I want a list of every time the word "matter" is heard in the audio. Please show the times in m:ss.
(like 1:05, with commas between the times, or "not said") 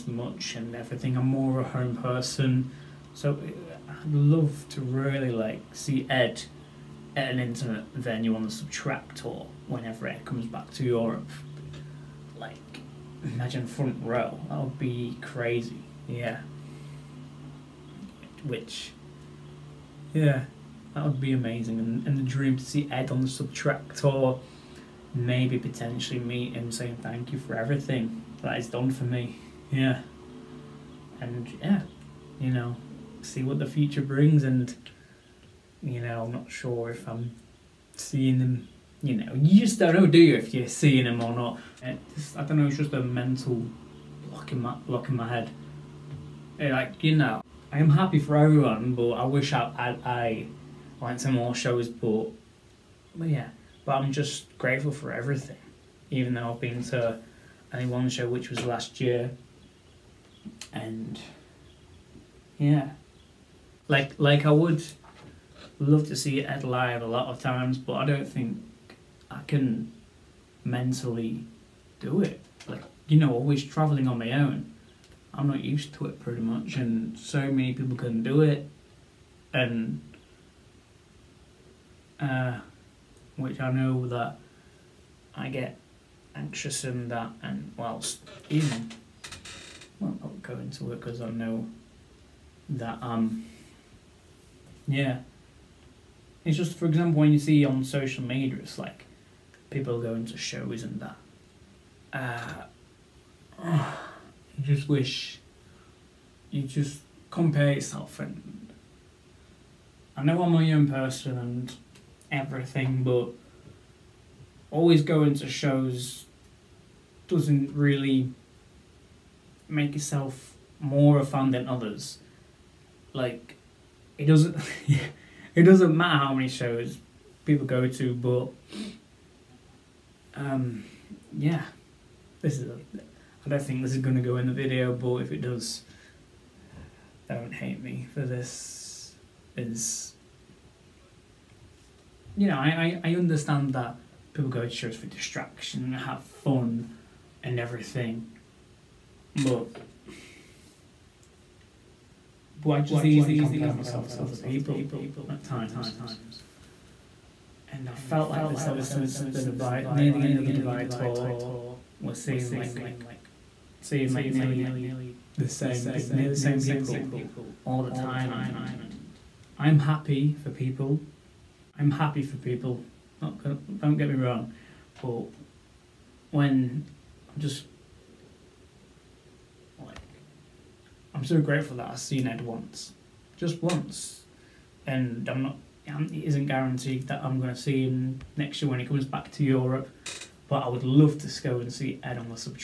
2:05.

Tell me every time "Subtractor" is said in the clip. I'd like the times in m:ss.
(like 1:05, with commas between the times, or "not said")
0:08, 0:23.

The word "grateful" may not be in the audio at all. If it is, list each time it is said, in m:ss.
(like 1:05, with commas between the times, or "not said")
0:54, 3:01.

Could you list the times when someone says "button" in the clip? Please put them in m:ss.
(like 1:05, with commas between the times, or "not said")
not said.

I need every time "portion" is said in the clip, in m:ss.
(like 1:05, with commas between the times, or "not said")
not said.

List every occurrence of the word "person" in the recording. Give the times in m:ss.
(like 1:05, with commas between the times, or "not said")
0:01, 1:50.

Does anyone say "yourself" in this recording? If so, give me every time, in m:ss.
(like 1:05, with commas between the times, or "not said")
1:47, 1:59.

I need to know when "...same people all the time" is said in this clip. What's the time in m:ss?
2:46.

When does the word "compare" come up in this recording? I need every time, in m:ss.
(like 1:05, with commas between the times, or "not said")
1:47, 2:33.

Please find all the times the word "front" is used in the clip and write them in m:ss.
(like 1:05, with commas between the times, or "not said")
0:13.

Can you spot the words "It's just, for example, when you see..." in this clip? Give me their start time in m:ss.
1:36.